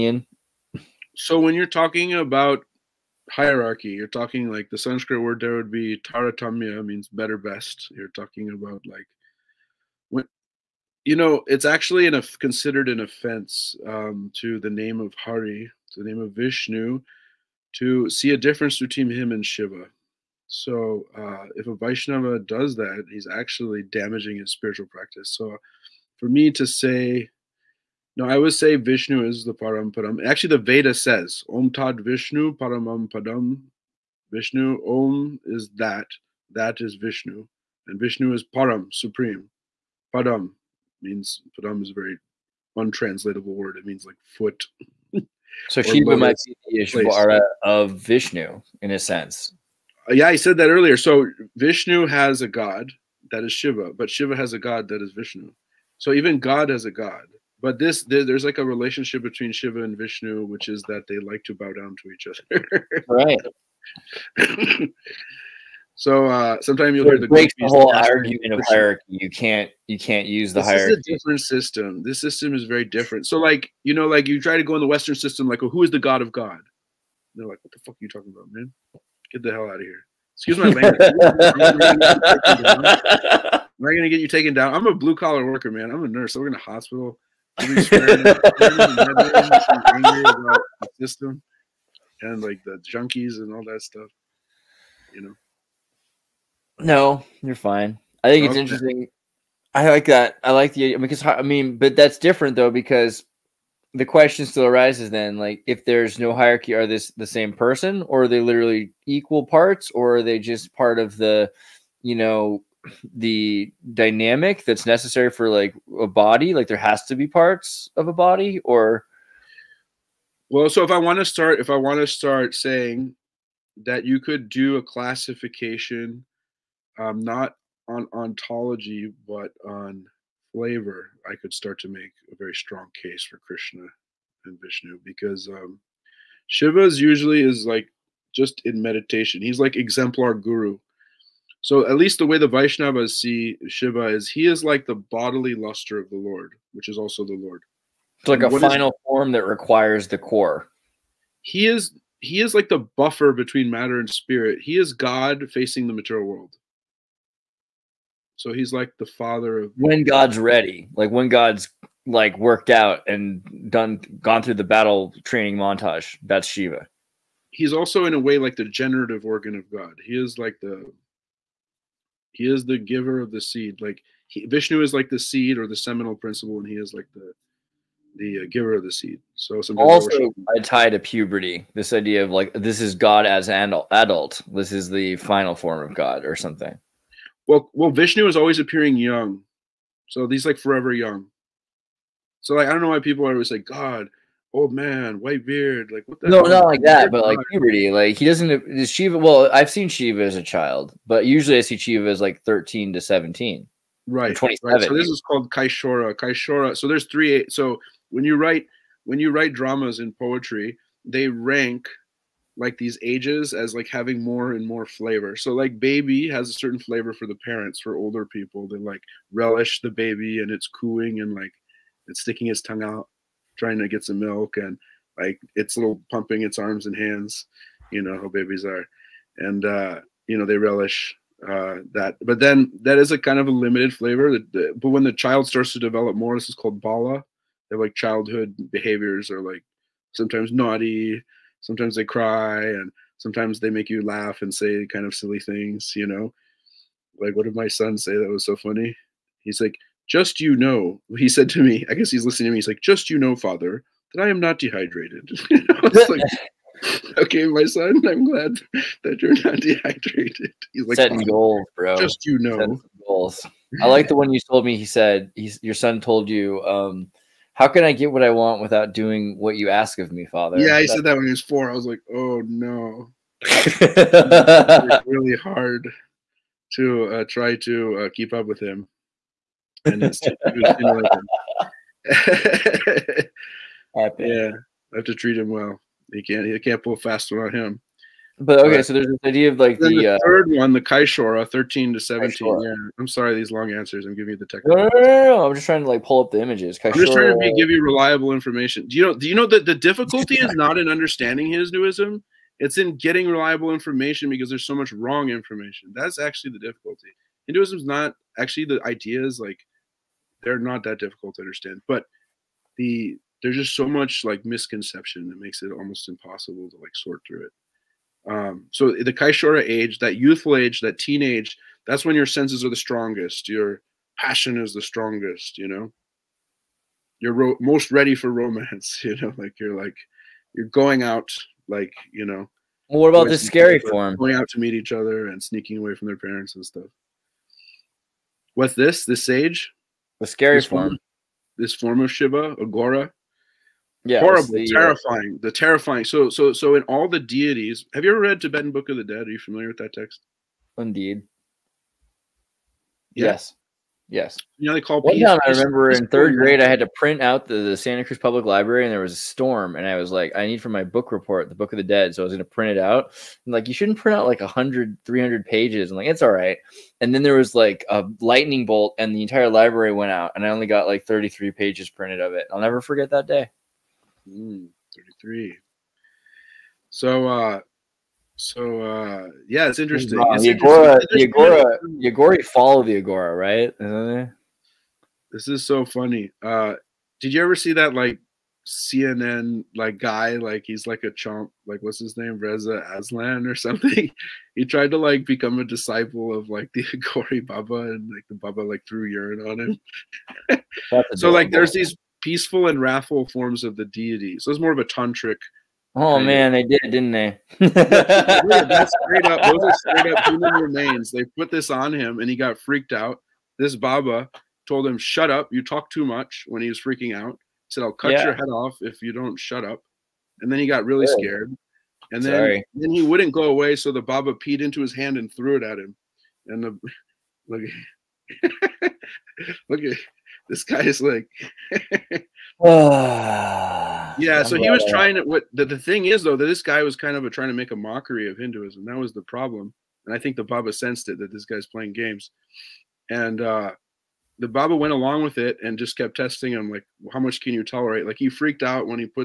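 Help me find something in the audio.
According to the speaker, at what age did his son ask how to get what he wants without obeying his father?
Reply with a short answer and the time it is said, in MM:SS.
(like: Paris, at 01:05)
4, at 04:31.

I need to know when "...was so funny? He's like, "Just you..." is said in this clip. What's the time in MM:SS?
04:08.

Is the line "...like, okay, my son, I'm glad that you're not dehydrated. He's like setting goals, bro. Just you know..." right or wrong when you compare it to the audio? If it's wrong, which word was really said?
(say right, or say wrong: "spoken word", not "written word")
right.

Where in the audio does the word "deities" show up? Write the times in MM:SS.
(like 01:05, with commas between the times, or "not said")
05:47, 06:43.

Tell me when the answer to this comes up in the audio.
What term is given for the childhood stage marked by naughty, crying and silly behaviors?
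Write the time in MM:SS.
03:56.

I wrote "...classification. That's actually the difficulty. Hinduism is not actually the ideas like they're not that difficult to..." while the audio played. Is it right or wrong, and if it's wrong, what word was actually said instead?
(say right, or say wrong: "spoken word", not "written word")
wrong: "information", not "classification".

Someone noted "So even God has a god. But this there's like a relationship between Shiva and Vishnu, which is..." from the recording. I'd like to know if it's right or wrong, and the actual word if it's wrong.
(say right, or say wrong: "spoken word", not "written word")
right.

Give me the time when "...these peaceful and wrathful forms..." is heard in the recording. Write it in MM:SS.
06:41.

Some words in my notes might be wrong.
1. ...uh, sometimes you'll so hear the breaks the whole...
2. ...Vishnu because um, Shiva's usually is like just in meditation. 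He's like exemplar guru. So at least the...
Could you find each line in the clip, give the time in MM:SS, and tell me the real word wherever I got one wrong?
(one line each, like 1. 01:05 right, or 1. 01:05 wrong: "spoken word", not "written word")
1. 01:06 right
2. 02:14 right.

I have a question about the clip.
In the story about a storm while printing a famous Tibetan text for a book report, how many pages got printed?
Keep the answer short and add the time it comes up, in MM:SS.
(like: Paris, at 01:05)
33, at 06:11.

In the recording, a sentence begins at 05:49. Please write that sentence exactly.
Are you familiar with that text?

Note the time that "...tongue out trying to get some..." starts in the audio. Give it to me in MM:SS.
03:42.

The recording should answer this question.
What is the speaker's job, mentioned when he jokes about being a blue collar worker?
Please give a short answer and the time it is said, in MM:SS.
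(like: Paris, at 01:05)
Nurse, at 01:25.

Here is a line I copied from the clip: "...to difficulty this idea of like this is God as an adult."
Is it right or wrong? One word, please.
wrong.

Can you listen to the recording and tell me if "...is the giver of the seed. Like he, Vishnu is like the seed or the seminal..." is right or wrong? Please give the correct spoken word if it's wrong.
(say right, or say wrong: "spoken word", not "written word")
right.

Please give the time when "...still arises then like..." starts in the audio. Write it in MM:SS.
01:44.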